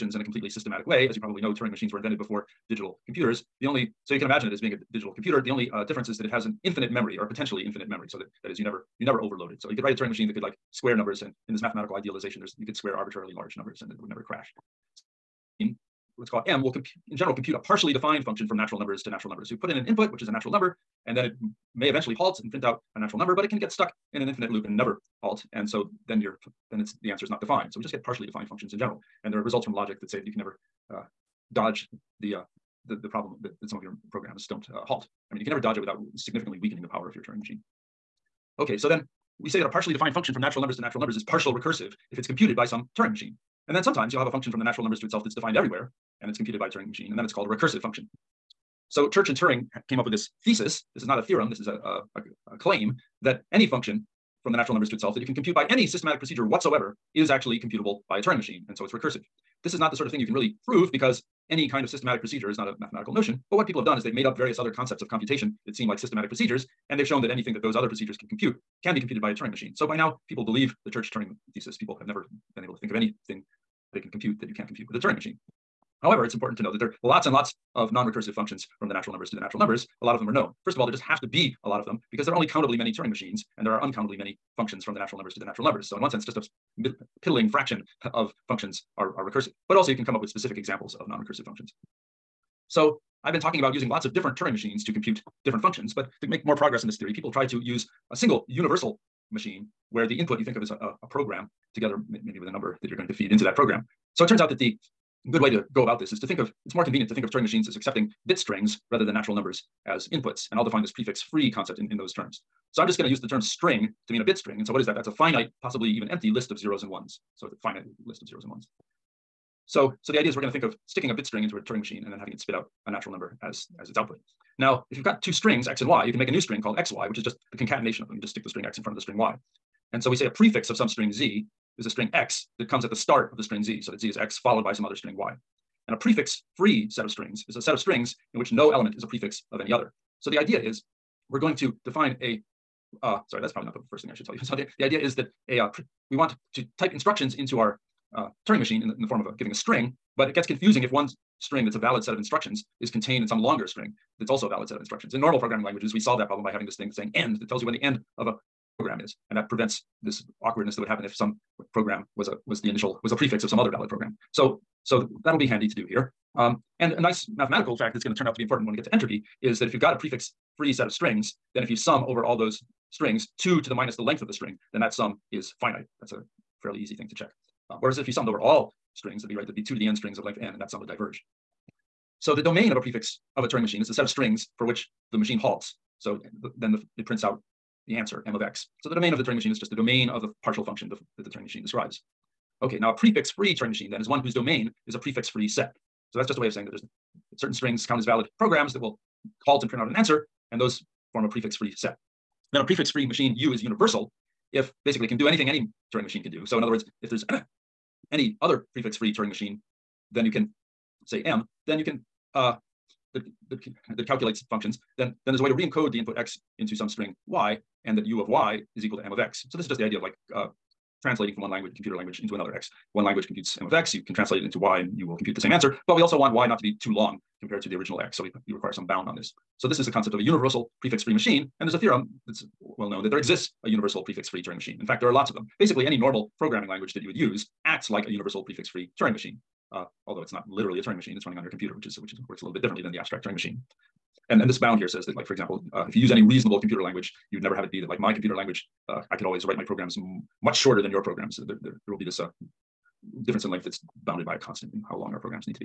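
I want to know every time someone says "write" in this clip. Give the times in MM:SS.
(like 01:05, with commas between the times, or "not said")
00:09, 04:09.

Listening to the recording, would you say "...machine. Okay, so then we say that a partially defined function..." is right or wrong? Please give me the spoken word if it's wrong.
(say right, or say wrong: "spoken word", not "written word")
right.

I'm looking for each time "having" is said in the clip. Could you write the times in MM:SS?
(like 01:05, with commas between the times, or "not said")
02:02, 02:36.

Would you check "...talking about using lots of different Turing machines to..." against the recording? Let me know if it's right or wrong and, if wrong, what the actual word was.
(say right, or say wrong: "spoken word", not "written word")
right.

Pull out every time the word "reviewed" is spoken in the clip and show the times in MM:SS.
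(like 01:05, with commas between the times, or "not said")
not said.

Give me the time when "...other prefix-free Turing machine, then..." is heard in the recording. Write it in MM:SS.
03:28.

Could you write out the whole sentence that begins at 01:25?
So in one sense, just a piddling fraction of functions are, are recursive.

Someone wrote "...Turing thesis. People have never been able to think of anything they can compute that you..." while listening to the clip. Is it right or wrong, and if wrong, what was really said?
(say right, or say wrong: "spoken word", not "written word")
right.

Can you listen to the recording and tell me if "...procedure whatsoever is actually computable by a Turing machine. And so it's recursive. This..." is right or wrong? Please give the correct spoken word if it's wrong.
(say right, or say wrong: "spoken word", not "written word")
right.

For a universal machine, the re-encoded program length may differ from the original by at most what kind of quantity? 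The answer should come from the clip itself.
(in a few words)
a constant.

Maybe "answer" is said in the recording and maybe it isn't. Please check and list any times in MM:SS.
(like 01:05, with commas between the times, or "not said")
00:27, 03:07, 03:19, 03:45.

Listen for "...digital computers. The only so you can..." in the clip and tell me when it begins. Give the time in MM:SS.
00:02.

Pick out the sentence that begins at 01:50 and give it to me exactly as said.
And I'll define this prefix free concept in, in those terms.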